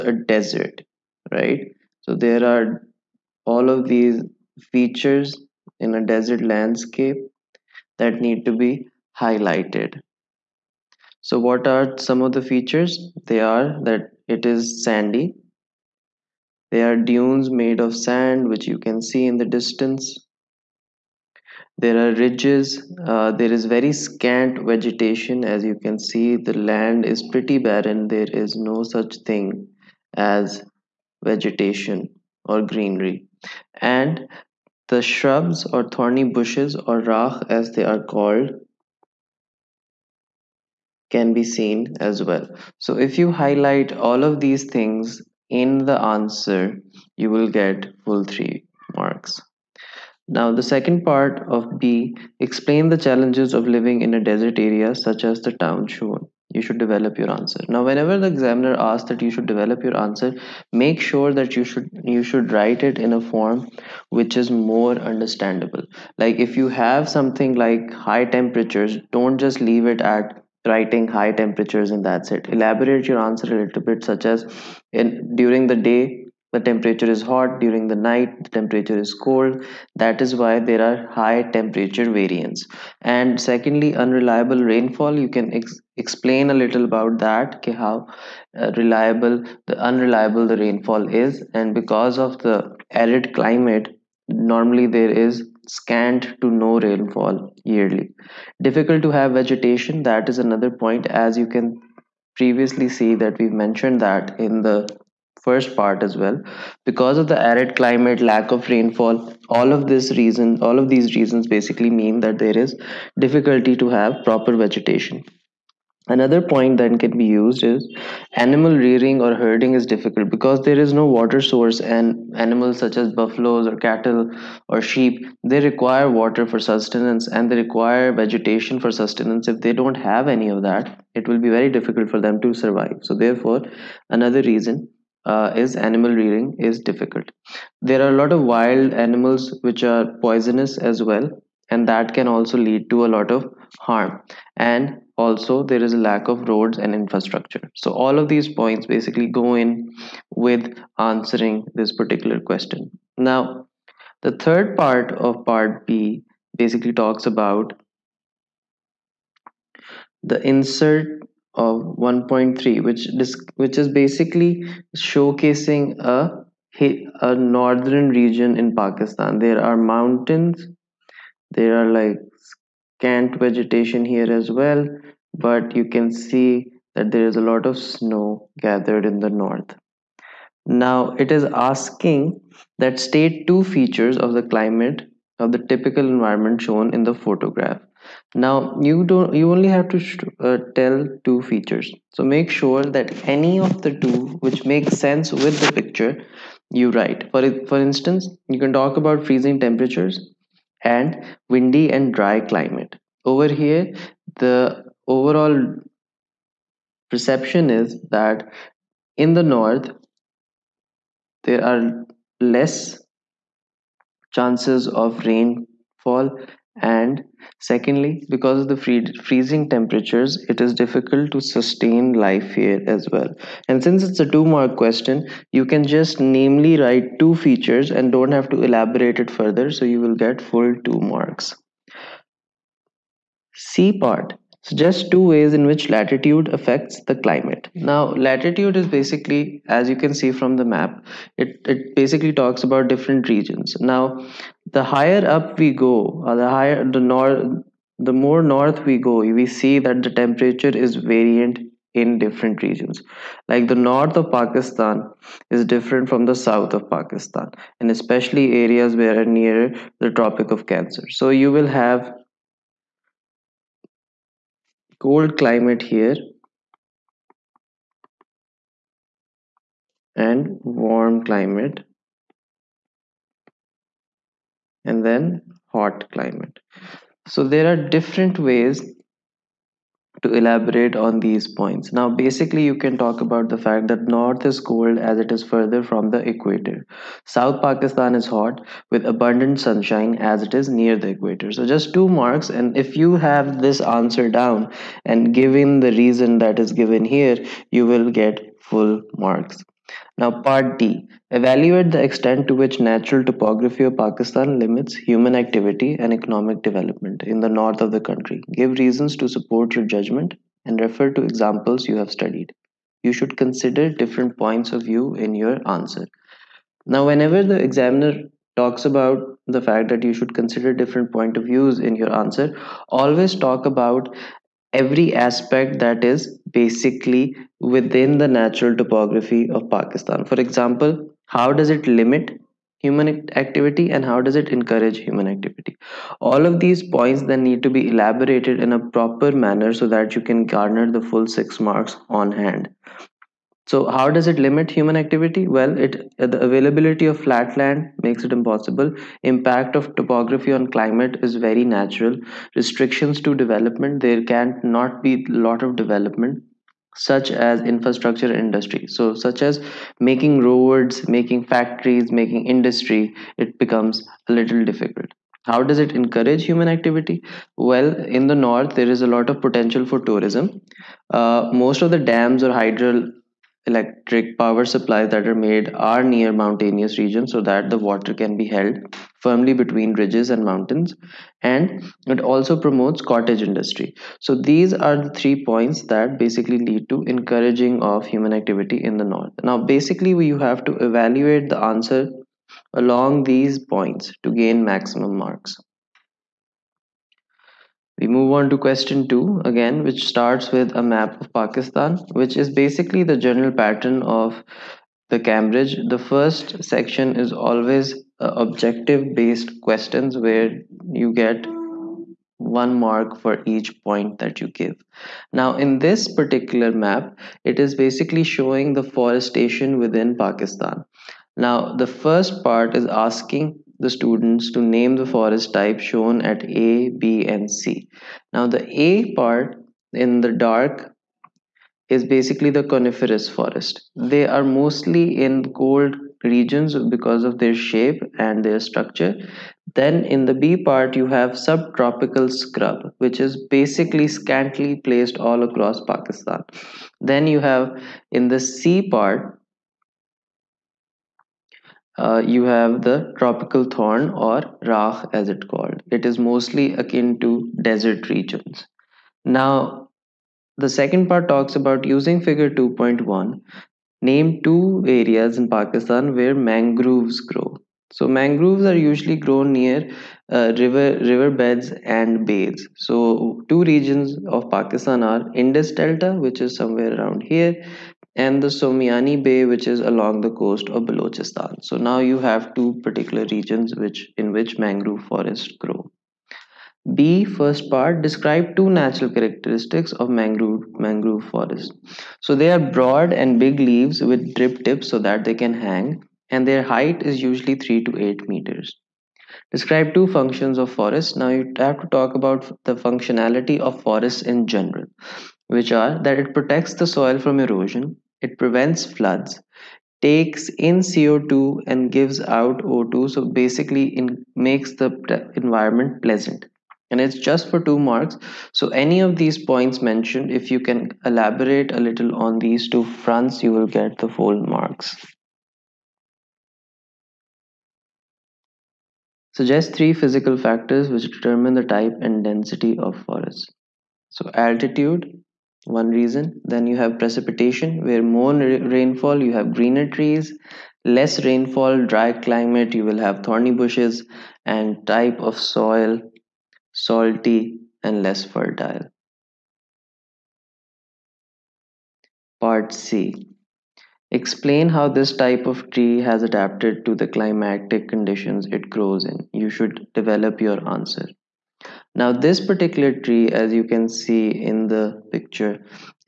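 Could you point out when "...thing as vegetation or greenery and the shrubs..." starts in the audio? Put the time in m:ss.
0:29.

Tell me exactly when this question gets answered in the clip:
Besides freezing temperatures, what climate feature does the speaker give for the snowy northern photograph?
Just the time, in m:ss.
3:21.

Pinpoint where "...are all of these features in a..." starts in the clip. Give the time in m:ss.
0:02.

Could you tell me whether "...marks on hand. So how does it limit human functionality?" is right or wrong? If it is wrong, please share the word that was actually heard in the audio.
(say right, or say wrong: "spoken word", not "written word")
wrong: "activity", not "functionality".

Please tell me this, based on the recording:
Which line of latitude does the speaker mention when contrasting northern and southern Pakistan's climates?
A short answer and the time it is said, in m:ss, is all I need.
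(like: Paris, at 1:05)
Tropic of Cancer, at 4:20.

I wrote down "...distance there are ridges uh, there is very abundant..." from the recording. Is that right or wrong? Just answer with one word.
wrong.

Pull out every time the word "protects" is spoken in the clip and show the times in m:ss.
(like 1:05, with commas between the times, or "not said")
8:26.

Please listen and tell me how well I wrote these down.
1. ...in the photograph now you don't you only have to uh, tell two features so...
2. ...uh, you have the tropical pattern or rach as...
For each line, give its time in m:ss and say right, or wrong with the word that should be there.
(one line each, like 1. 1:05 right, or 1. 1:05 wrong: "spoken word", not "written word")
1. 3:06 right
2. 7:31 wrong: "thorn", not "pattern".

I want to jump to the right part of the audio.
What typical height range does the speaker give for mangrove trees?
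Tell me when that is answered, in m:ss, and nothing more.
8:17.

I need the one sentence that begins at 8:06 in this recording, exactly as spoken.
B first part describe two natural characteristics of mangrove mangrove forest.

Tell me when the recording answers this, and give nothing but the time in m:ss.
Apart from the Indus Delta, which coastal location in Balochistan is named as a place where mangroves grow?
7:58.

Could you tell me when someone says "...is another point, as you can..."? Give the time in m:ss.
1:40.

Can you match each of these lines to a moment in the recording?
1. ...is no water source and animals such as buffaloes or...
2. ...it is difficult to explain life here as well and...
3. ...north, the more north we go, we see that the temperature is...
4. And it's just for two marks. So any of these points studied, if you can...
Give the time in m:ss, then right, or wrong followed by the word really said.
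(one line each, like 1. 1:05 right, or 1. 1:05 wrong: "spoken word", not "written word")
1. 2:00 right
2. 3:40 wrong: "sustain", not "explain"
3. 4:06 right
4. 8:36 wrong: "mentioned", not "studied".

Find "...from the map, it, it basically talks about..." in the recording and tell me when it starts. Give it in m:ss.
4:00.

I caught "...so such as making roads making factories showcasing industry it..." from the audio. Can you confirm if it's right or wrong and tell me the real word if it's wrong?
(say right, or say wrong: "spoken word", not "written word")
wrong: "making", not "showcasing".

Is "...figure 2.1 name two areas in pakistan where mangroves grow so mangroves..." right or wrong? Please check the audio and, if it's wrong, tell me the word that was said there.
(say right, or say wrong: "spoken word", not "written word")
right.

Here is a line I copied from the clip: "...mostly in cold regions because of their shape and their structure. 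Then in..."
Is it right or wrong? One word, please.
right.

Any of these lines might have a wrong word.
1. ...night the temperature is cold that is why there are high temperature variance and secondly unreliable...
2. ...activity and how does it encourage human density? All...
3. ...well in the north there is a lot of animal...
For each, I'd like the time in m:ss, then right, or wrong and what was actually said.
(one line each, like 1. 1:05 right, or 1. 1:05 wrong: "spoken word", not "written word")
1. 1:17 right
2. 5:33 wrong: "activity", not "density"
3. 6:07 wrong: "potential", not "animal".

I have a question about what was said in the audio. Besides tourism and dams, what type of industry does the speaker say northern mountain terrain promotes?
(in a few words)
cottage industry.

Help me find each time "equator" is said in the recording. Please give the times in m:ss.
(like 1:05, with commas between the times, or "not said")
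4:46, 4:51.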